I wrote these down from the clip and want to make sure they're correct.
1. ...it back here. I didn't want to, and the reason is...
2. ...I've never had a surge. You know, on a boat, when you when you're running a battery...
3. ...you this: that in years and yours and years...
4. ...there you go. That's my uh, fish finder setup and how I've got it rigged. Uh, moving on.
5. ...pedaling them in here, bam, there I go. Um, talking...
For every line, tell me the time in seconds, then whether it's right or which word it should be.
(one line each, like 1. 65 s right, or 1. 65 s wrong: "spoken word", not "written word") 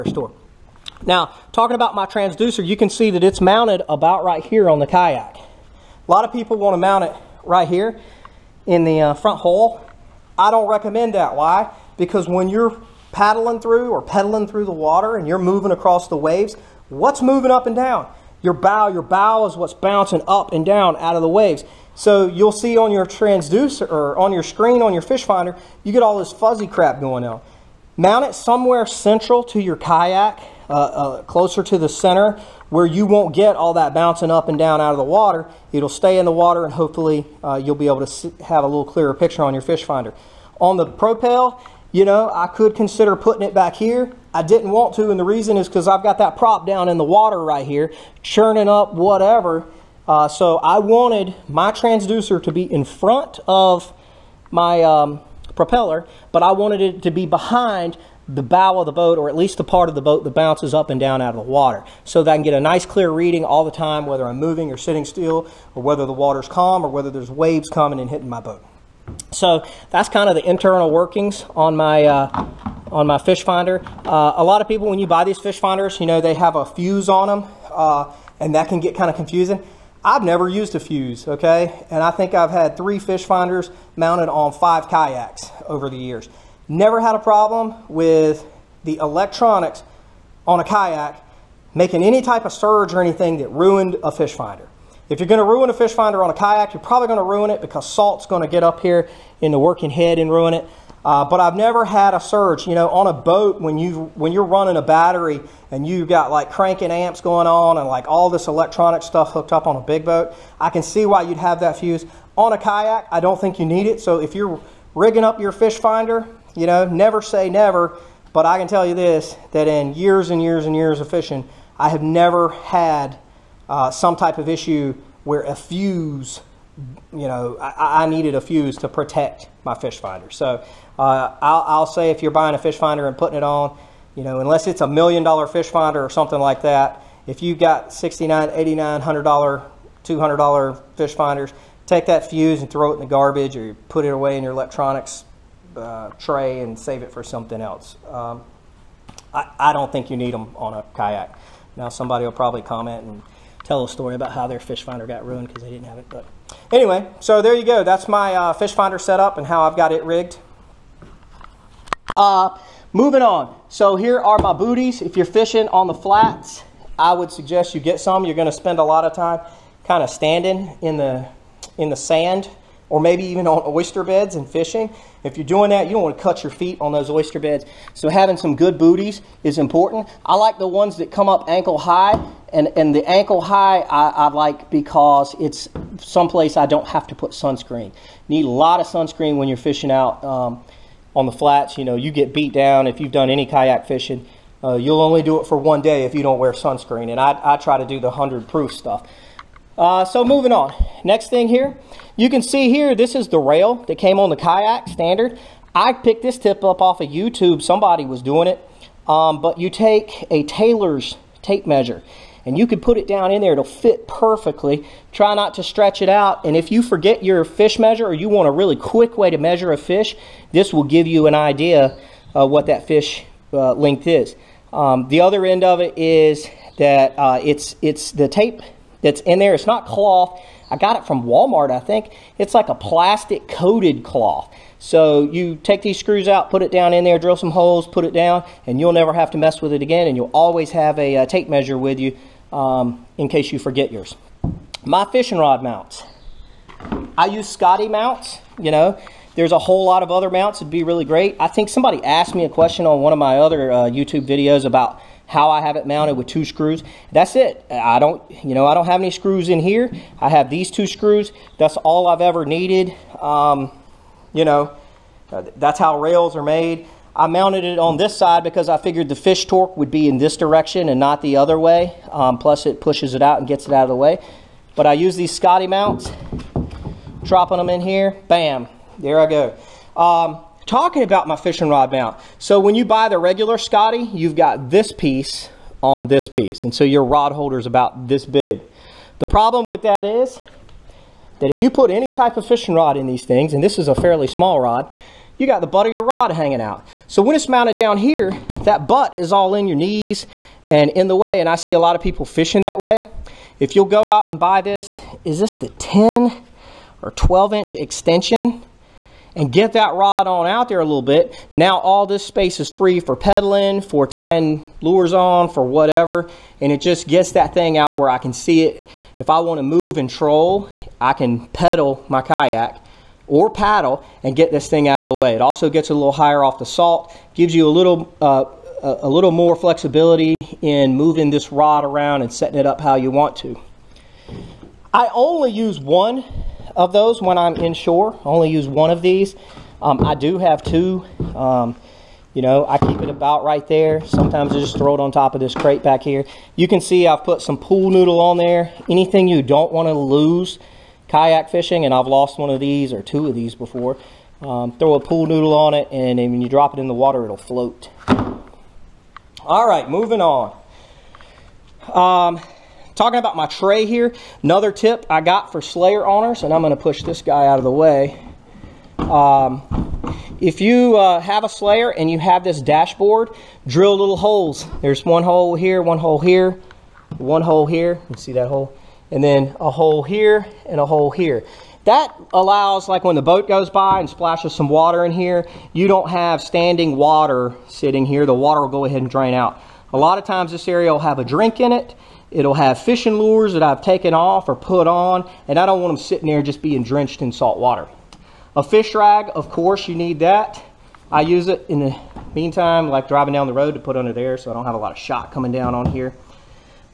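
1. 43 s right
2. 101 s right
3. 118 s wrong: "years", not "yours"
4. 157 s right
5. 277 s wrong: "dropping", not "pedaling".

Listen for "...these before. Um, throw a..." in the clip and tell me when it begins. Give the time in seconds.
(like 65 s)
353 s.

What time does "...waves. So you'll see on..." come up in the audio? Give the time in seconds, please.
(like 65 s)
21 s.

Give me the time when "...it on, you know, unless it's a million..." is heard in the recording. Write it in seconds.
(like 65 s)
133 s.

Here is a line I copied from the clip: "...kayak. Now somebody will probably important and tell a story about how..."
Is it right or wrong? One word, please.
wrong.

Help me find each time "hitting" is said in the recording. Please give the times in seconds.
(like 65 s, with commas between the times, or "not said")
68 s.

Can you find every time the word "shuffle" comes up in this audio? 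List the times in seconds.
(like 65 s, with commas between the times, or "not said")
not said.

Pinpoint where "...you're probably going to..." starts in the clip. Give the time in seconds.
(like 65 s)
96 s.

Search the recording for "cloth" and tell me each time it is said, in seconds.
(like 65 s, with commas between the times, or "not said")
229 s, 234 s.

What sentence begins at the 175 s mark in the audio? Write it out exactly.
If you're doing that, you don't want to cut your feet on those oyster beds.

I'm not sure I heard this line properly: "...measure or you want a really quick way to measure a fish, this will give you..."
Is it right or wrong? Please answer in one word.
right.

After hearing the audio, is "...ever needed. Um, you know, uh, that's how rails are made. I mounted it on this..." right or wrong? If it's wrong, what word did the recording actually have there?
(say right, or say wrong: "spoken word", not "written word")
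right.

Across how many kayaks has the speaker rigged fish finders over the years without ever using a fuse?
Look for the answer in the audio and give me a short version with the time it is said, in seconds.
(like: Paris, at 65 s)
5, at 84 s.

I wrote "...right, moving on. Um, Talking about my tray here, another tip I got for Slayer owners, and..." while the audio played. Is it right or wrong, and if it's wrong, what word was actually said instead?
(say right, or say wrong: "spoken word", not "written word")
right.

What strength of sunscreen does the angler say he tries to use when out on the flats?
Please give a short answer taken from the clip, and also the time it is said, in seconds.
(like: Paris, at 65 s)
100 proof, at 198 s.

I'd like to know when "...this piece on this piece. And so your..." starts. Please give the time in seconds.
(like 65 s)
284 s.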